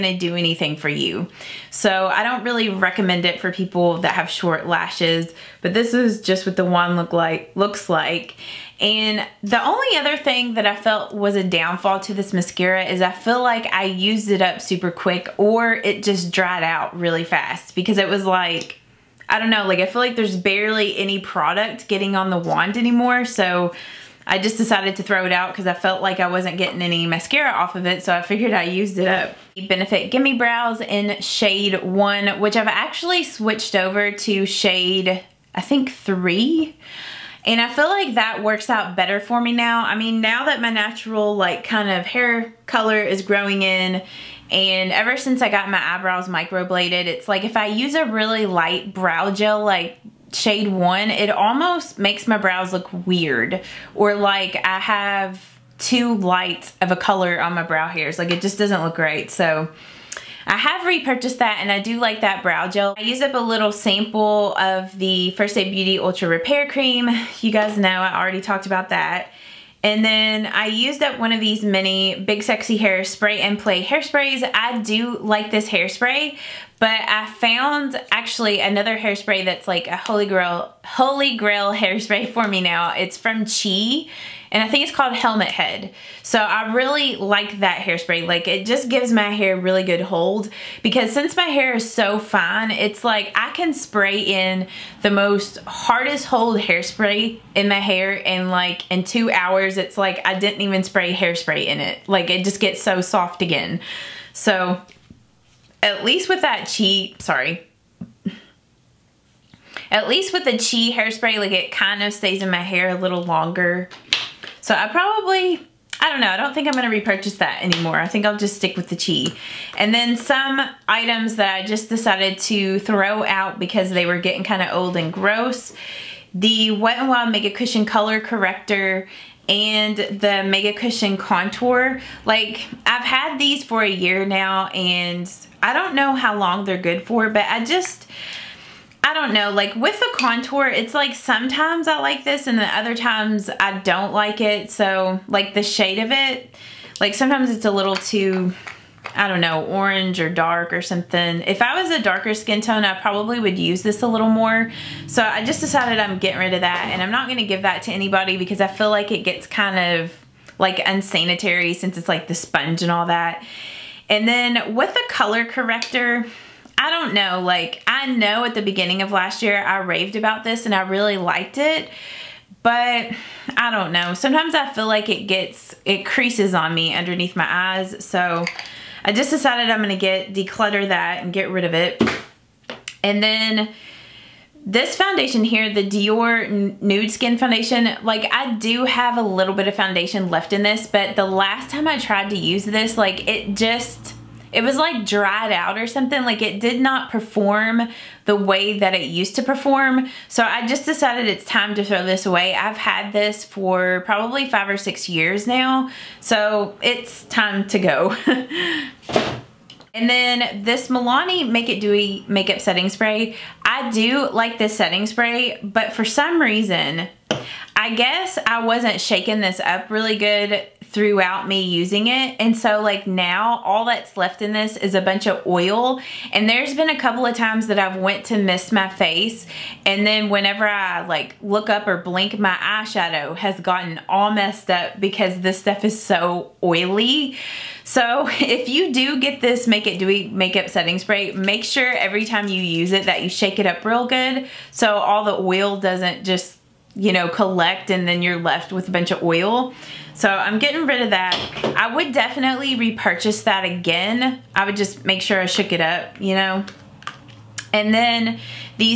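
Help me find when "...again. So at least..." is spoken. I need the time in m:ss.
1:43.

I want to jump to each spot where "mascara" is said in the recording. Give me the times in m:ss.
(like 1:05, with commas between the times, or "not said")
0:12, 0:27.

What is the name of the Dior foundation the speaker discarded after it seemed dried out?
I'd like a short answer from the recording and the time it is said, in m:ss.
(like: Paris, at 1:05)
Nude Skin, at 3:06.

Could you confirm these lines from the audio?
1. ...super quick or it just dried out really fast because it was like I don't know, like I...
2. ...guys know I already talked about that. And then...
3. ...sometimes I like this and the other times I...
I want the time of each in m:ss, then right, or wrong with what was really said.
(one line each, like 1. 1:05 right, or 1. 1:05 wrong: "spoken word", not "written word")
1. 0:14 right
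2. 1:07 right
3. 2:21 right.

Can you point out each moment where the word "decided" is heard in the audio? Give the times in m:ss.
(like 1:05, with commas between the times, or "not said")
0:24, 2:01, 2:35, 2:59, 3:20.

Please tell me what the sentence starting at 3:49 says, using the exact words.
And then whenever I like look up or blink, my eyeshadow has gotten all messed up because this stuff is so oily.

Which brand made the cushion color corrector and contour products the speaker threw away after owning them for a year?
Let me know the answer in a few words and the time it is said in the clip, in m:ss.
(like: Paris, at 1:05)
Wet n Wild, at 2:06.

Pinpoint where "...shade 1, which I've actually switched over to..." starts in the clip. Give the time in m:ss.
0:31.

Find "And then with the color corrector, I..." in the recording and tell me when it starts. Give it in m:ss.
2:44.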